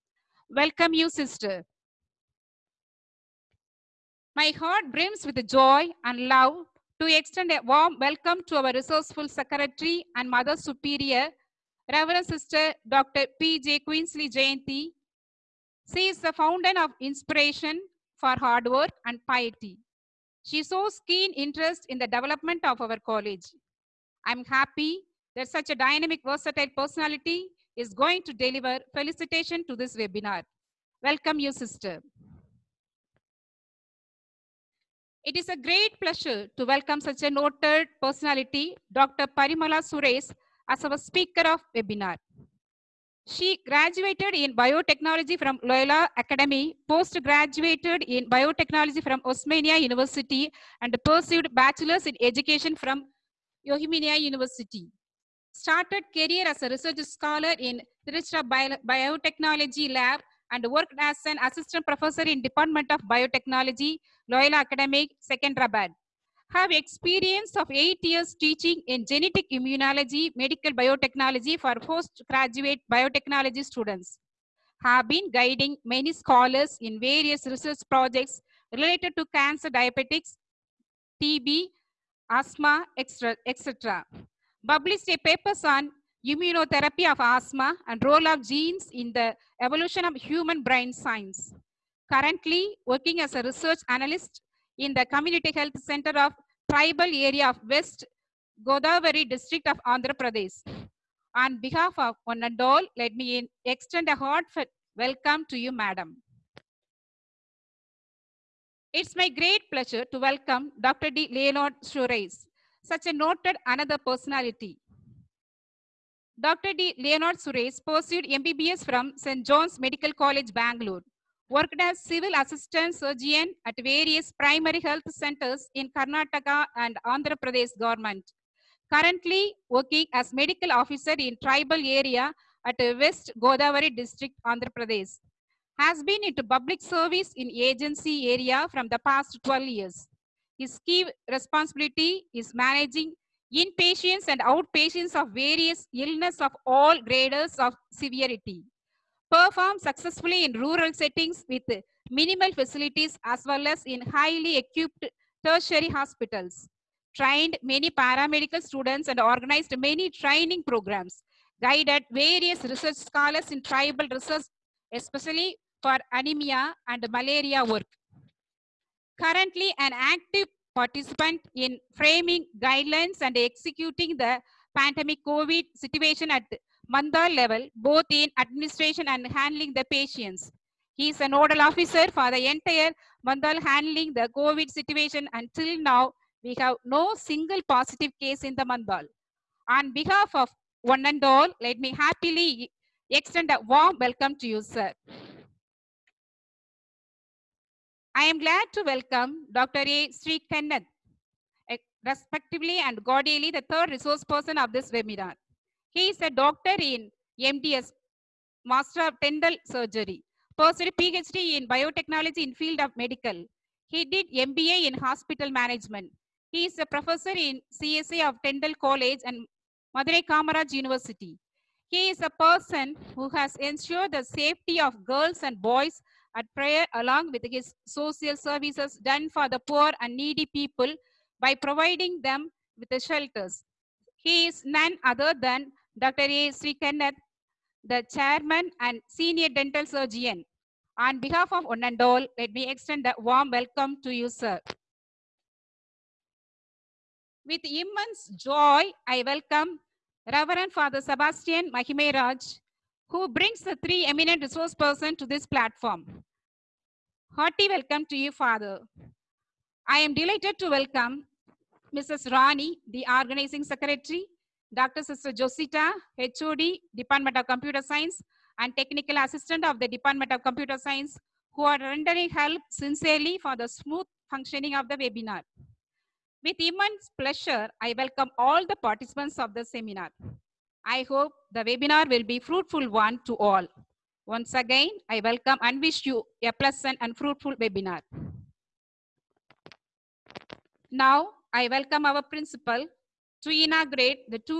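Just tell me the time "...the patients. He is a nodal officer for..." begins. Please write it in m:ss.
2:59.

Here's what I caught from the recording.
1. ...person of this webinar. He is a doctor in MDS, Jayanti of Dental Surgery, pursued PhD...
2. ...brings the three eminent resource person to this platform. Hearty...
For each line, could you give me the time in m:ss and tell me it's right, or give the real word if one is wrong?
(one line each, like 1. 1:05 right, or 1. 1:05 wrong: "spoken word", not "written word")
1. 3:24 wrong: "Master", not "Jayanti"
2. 4:13 right.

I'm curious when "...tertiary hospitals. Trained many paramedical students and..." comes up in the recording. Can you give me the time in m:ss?
2:35.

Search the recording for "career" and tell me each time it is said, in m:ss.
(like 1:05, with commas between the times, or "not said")
0:56.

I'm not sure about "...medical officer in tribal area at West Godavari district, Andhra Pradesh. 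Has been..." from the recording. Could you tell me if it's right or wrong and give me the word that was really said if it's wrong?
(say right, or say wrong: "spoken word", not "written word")
right.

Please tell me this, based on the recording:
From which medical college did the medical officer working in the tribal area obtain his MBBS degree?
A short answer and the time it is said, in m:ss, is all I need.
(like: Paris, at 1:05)
St. John's Medical College, at 1:59.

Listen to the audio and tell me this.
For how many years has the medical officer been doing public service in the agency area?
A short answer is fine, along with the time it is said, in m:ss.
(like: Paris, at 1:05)
12, at 2:19.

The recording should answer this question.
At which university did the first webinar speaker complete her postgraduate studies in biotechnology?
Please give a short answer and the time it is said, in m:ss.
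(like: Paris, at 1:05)
Osmania University, at 0:49.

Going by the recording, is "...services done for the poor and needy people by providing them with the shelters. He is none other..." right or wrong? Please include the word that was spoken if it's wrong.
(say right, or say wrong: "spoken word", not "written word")
right.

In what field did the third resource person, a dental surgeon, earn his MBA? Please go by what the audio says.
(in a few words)
Hospital Management.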